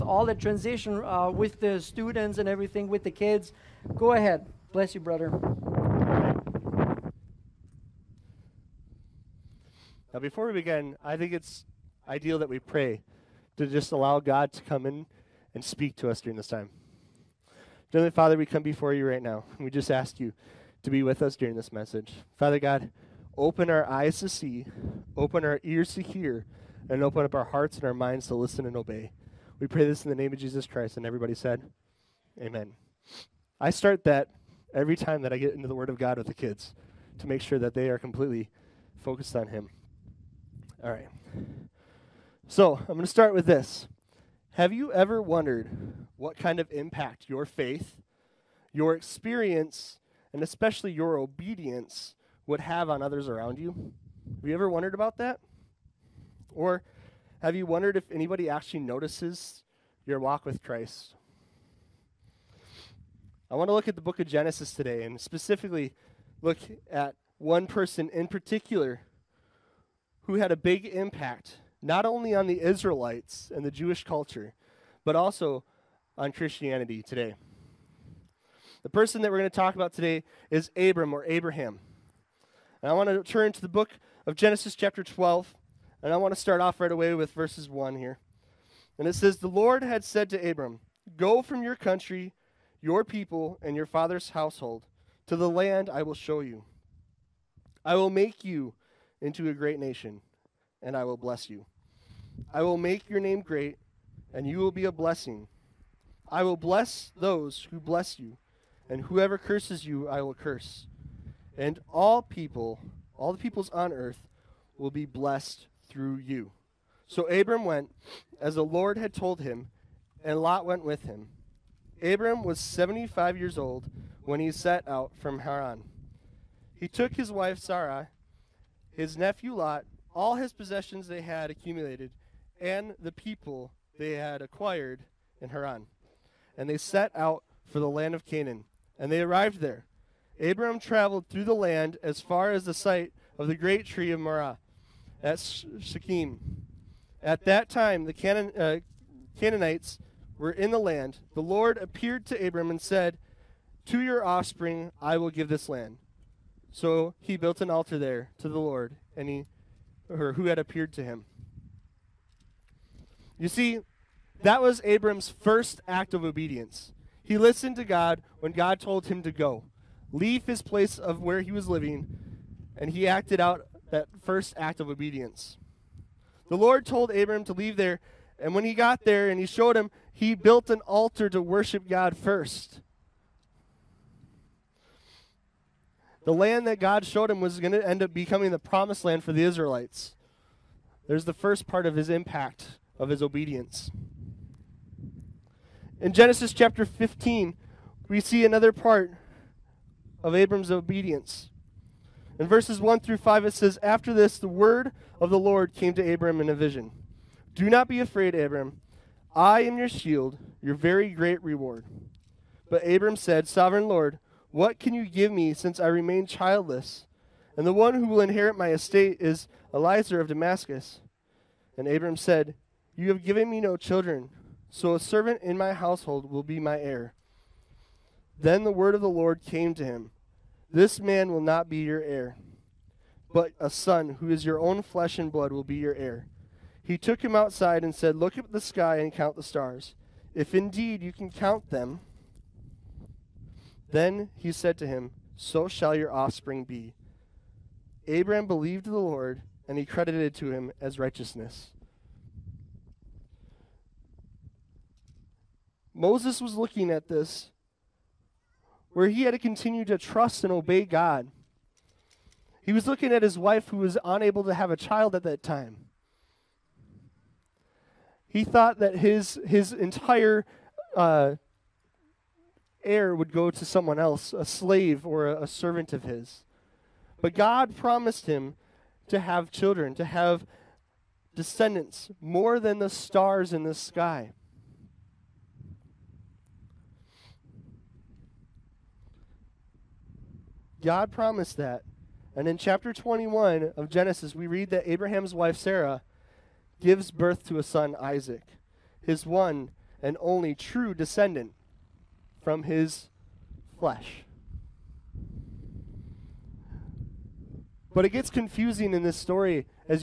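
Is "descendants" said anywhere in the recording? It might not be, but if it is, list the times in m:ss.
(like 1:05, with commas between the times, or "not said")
4:41, 5:00.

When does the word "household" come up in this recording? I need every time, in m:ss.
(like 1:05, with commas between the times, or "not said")
1:34, 3:45.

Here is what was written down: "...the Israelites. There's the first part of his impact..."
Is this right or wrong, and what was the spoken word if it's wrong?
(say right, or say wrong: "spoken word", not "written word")
right.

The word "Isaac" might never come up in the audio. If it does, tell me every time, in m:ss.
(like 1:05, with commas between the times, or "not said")
4:57.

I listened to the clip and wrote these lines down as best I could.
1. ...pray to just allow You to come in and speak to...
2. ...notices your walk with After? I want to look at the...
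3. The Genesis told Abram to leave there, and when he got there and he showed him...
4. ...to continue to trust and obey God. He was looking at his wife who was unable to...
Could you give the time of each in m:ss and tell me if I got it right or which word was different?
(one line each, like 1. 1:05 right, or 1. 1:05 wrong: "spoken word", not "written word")
1. 0:12 wrong: "God", not "You"
2. 0:58 wrong: "Christ", not "After"
3. 2:56 wrong: "Lord", not "Genesis"
4. 4:19 right.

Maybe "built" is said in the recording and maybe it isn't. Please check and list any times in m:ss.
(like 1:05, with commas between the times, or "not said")
2:37, 3:00.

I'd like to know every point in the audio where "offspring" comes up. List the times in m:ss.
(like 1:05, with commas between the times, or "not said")
2:34, 4:06.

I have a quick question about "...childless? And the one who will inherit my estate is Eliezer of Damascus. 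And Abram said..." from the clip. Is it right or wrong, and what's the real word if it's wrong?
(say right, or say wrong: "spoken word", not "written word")
right.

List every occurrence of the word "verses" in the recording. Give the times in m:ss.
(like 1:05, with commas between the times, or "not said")
1:27, 3:22.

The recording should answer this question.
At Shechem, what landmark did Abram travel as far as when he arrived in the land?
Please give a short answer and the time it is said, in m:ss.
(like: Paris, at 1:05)
the great tree of Moreh, at 2:23.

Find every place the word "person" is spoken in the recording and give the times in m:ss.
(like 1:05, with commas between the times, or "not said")
1:07, 1:18.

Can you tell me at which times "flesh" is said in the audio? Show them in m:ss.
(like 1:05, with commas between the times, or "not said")
3:54, 5:03.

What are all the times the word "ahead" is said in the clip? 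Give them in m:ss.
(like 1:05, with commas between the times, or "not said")
0:04.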